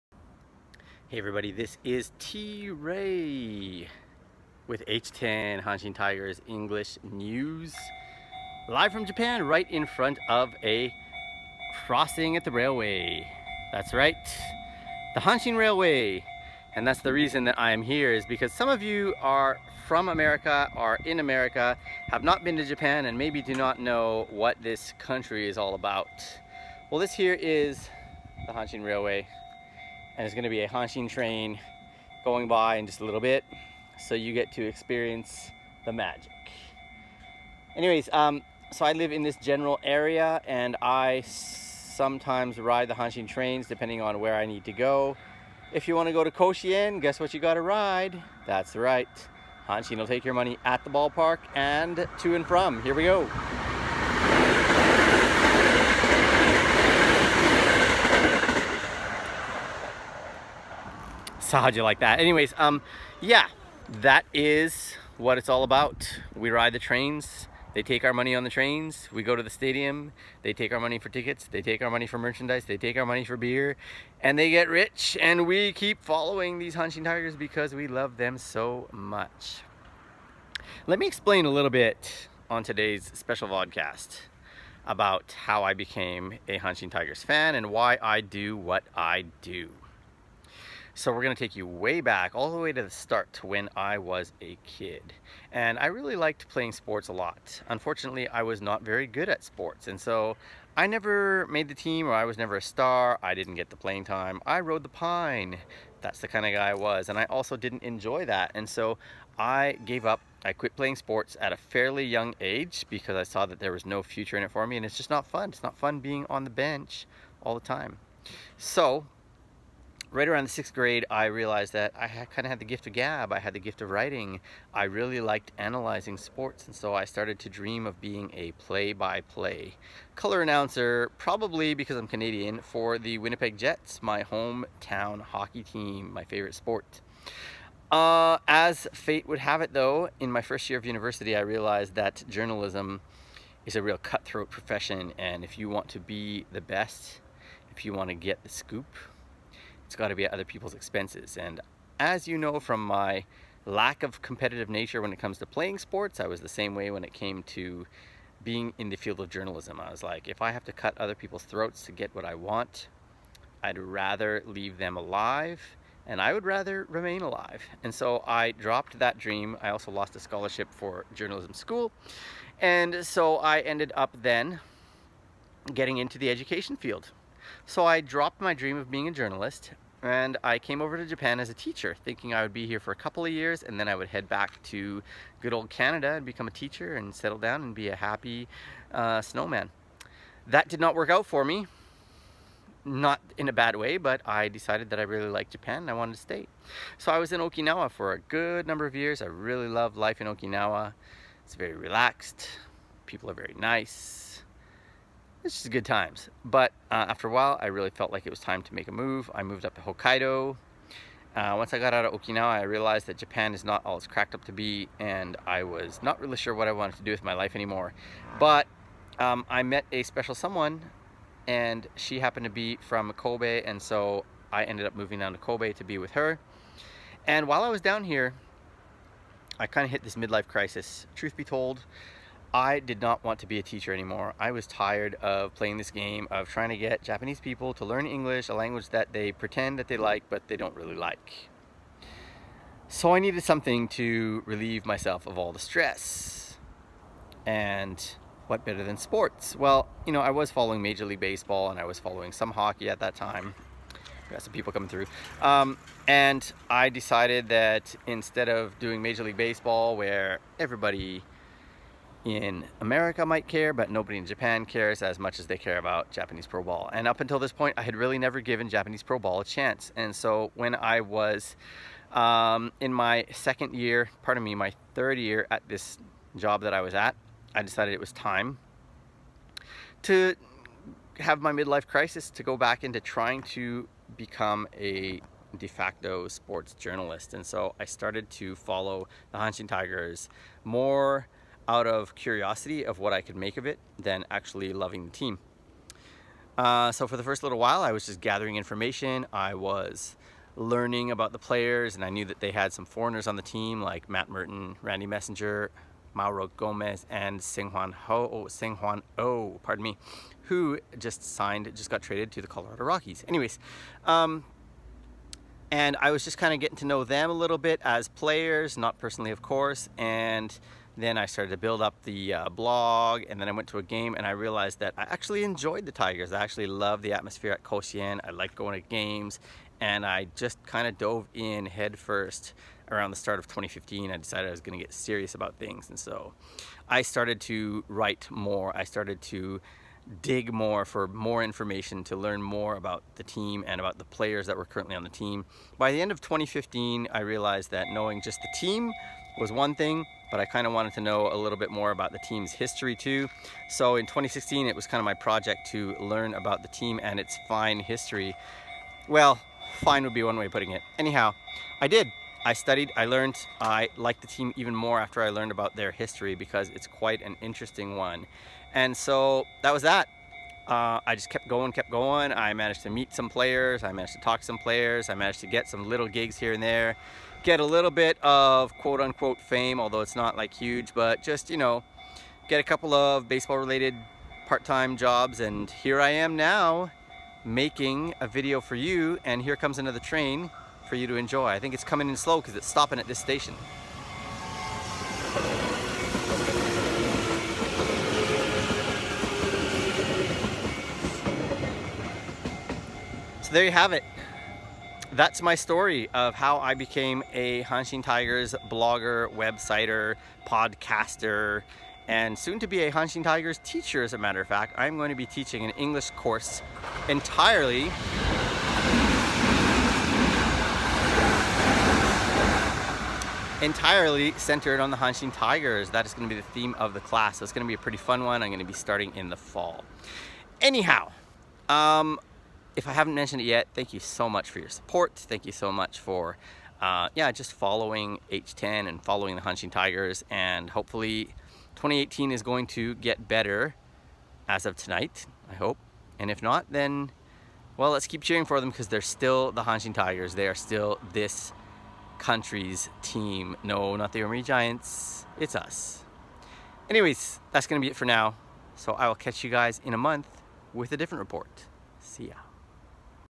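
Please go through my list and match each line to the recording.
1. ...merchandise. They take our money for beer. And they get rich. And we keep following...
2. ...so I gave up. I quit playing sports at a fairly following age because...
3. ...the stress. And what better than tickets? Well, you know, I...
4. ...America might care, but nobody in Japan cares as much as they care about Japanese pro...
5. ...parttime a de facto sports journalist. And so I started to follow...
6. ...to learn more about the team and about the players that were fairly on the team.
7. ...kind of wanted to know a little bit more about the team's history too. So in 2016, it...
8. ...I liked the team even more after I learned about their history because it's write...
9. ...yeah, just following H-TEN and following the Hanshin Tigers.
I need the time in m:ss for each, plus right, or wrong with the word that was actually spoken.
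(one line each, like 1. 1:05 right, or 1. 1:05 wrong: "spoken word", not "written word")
1. 1:12 right
2. 1:48 wrong: "young", not "following"
3. 4:05 wrong: "sports", not "tickets"
4. 4:22 right
5. 4:44 wrong: "become", not "parttime"
6. 5:42 wrong: "currently", not "fairly"
7. 5:50 right
8. 6:03 wrong: "quite", not "write"
9. 7:17 right.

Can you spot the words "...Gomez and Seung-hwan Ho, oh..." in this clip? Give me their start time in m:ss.
5:06.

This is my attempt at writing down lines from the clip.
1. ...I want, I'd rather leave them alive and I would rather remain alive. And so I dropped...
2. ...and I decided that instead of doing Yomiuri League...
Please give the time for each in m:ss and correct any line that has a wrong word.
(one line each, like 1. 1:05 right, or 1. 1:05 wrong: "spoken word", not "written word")
1. 2:42 right
2. 4:16 wrong: "Major", not "Yomiuri".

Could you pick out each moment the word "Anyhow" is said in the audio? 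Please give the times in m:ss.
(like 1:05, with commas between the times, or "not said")
6:00, 7:10.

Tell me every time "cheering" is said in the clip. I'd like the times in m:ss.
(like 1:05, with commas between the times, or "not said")
7:28.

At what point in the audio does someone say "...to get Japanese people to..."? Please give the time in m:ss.
3:56.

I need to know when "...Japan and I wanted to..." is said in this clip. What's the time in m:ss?
3:15.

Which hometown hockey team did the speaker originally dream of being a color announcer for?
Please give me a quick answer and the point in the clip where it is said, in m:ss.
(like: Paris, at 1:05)
Winnipeg Jets, at 2:13.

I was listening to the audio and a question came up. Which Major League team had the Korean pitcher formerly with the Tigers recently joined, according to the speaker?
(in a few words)
Colorado Rockies.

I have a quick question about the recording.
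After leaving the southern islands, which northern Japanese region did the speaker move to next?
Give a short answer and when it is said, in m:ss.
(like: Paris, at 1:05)
Hokkaido, at 3:29.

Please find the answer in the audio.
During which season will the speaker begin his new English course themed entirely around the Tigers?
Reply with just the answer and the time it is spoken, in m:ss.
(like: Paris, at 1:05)
fall, at 7:09.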